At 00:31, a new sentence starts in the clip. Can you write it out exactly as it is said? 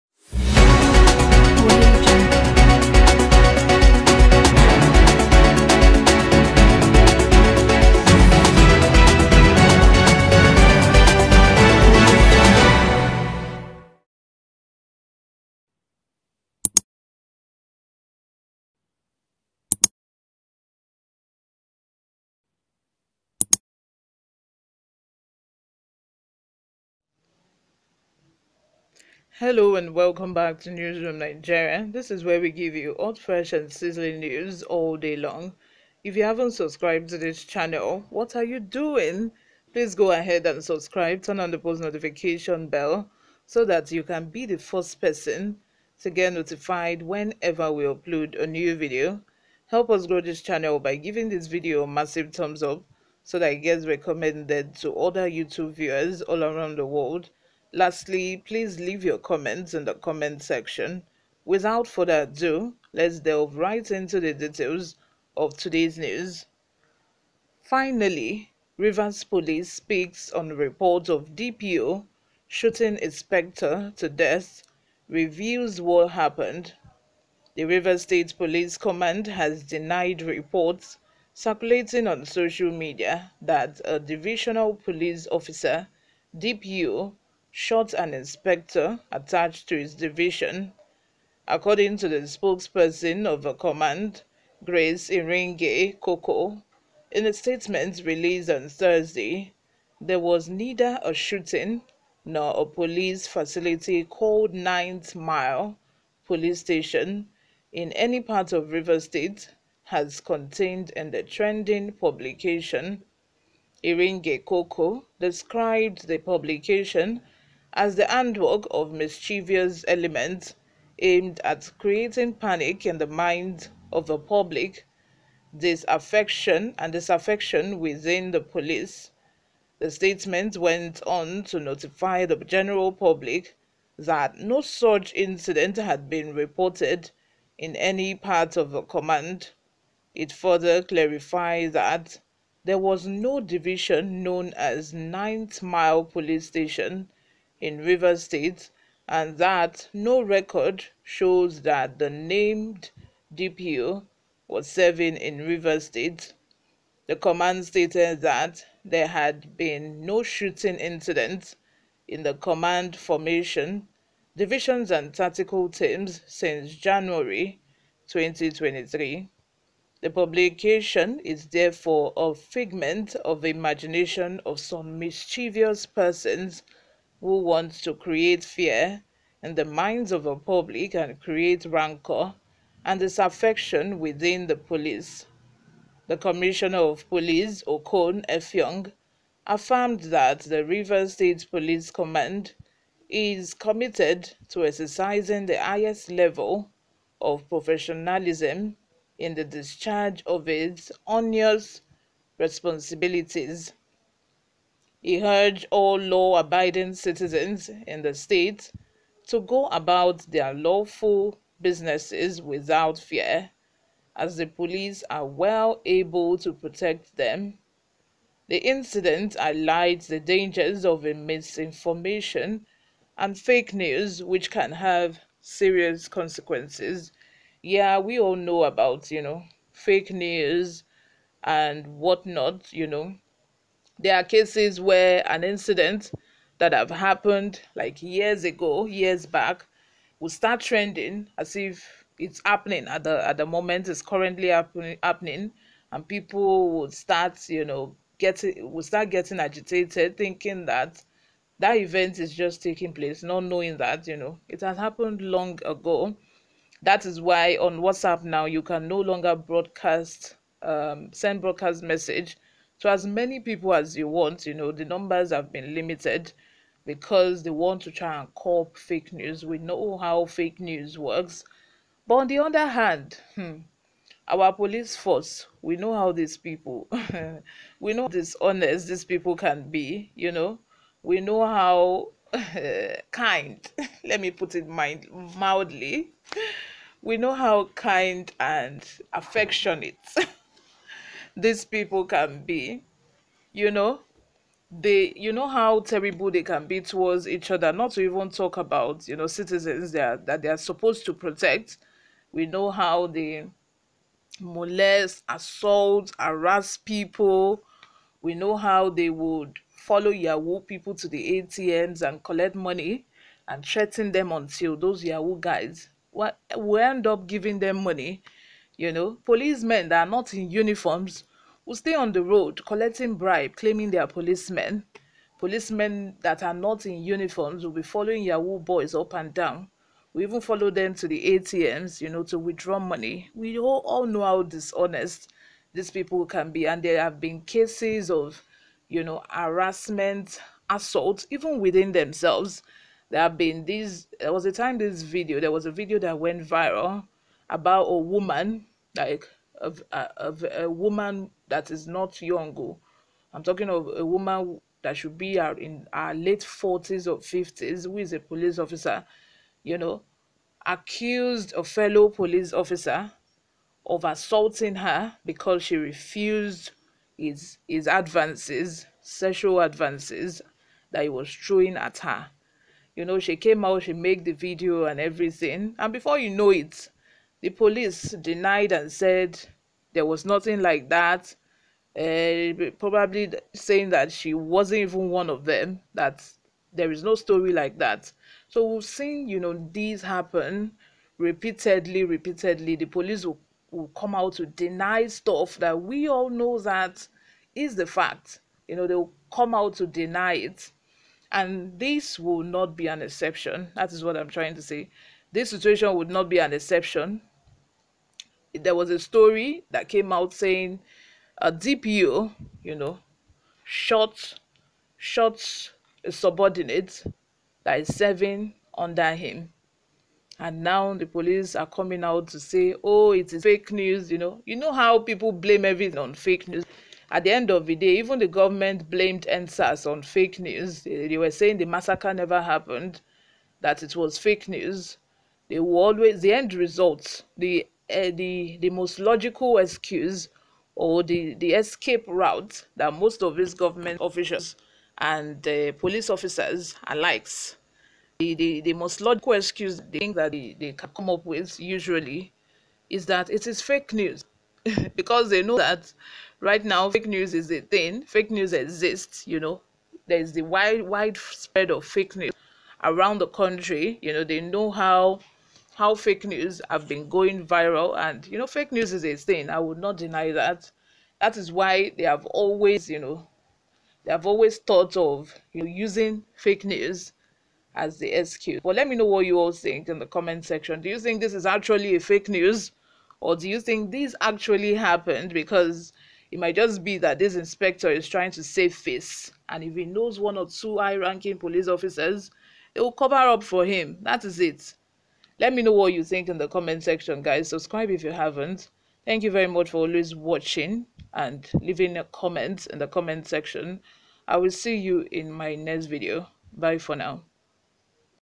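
This is where we give you hot, fresh and sizzling news all day long.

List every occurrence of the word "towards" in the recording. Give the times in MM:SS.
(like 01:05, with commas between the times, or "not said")
04:56.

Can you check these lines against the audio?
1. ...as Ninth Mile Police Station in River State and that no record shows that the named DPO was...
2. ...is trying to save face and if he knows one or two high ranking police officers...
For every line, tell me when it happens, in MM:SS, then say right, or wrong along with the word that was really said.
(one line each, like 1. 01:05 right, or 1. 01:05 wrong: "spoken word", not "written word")
1. 02:24 right
2. 08:07 right.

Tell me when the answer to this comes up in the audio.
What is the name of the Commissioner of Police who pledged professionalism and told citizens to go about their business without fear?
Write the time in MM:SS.
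03:07.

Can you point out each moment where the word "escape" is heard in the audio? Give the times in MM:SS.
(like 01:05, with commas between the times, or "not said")
07:21.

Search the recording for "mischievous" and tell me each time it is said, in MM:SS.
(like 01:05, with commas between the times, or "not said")
01:58, 02:54.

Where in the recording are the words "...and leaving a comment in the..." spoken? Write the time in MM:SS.
08:21.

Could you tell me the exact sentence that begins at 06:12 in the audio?
You know, she came out, she made the video and everything.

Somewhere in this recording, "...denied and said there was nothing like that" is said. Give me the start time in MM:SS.
06:18.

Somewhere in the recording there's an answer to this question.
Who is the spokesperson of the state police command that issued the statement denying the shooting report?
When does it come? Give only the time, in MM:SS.
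01:34.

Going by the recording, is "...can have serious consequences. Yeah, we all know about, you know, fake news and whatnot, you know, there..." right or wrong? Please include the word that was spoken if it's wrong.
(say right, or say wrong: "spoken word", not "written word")
right.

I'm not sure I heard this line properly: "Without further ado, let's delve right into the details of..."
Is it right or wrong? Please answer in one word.
right.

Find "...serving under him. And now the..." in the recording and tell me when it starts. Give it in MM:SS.
06:57.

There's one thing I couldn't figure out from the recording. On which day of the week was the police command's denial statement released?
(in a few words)
Thursday.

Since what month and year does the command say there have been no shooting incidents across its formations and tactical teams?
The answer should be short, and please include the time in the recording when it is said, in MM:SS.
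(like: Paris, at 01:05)
January 2023, at 02:46.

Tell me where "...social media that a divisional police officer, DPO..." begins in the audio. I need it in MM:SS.
01:22.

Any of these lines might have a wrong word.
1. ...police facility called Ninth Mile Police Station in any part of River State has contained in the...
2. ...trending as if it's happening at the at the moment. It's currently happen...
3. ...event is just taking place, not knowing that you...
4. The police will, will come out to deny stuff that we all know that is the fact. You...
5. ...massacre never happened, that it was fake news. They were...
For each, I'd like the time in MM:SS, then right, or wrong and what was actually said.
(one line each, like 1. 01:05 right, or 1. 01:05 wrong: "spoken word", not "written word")
1. 01:42 right
2. 04:00 right
3. 04:11 right
4. 06:32 right
5. 07:11 right.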